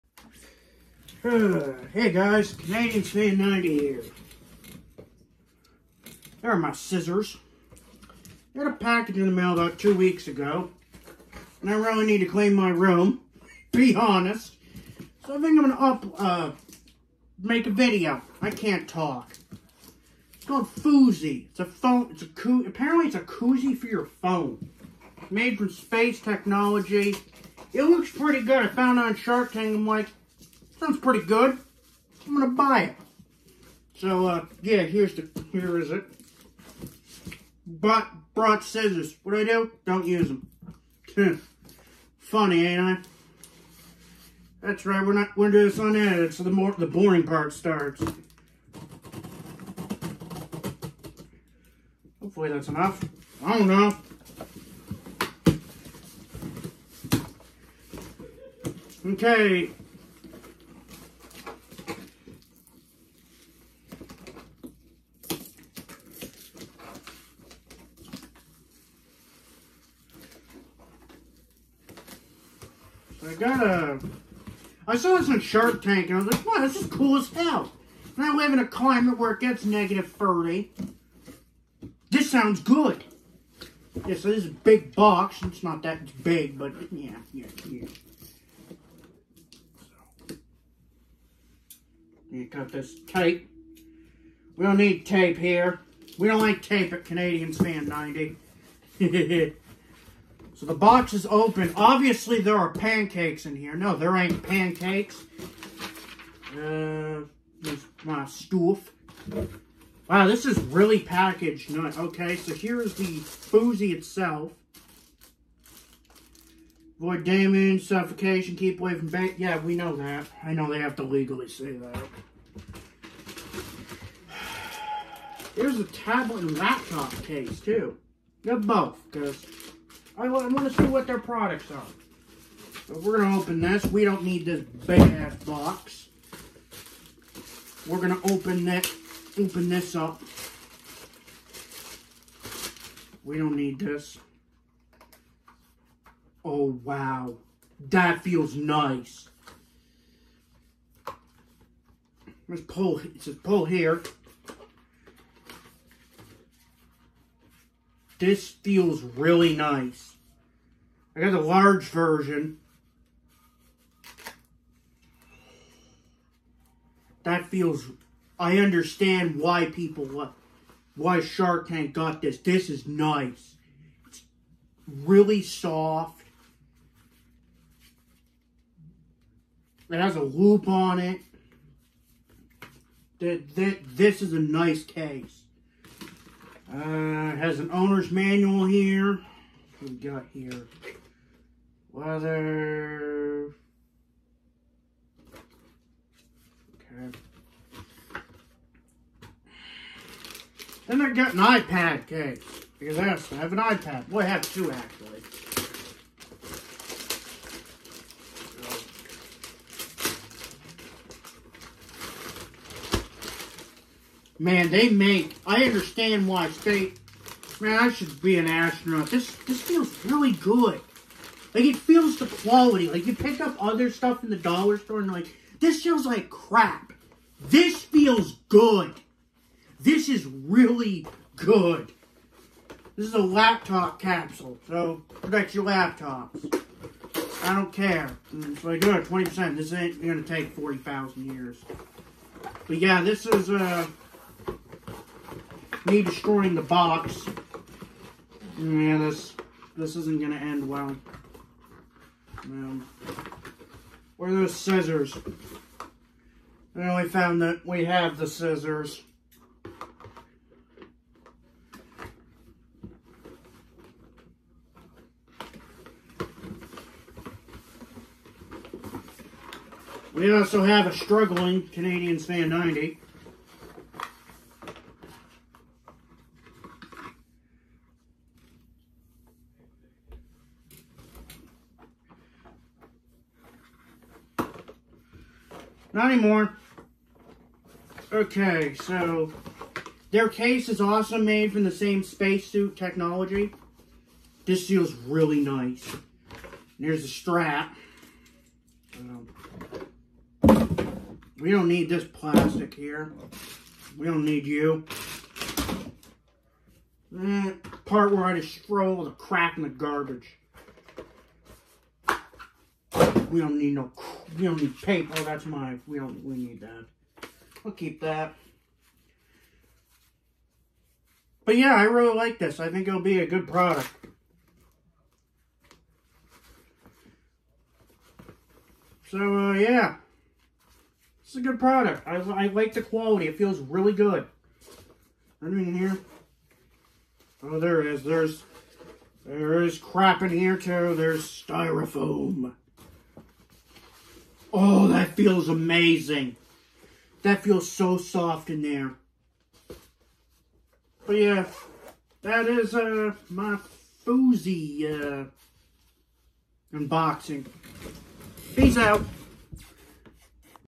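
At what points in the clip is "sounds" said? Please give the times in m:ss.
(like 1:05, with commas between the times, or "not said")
0:30, 1:22.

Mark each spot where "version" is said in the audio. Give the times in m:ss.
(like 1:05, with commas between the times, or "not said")
2:41.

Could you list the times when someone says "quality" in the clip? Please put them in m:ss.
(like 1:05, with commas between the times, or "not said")
3:42, 5:32.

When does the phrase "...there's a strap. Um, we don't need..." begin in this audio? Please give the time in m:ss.
4:56.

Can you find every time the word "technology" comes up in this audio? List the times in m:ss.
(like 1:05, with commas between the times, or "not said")
0:26, 4:52.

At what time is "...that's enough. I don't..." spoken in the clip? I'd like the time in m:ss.
0:52.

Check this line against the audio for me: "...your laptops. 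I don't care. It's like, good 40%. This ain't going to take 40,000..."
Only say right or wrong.
wrong.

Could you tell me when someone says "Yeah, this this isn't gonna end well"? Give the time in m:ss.
4:08.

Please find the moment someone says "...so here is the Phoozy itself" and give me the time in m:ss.
1:52.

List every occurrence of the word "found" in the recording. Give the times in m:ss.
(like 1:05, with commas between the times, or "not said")
0:28, 4:17.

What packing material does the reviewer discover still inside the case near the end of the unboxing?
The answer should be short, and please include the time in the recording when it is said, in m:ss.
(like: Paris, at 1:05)
Styrofoam, at 5:41.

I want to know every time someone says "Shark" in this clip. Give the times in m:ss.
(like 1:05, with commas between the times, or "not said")
0:29, 1:15, 2:51.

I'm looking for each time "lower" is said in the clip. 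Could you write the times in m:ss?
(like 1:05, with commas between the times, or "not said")
not said.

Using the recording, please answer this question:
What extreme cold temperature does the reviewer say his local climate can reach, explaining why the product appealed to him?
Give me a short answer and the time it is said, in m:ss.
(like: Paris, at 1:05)
-30, at 1:19.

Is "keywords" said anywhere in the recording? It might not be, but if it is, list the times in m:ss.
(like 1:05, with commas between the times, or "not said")
not said.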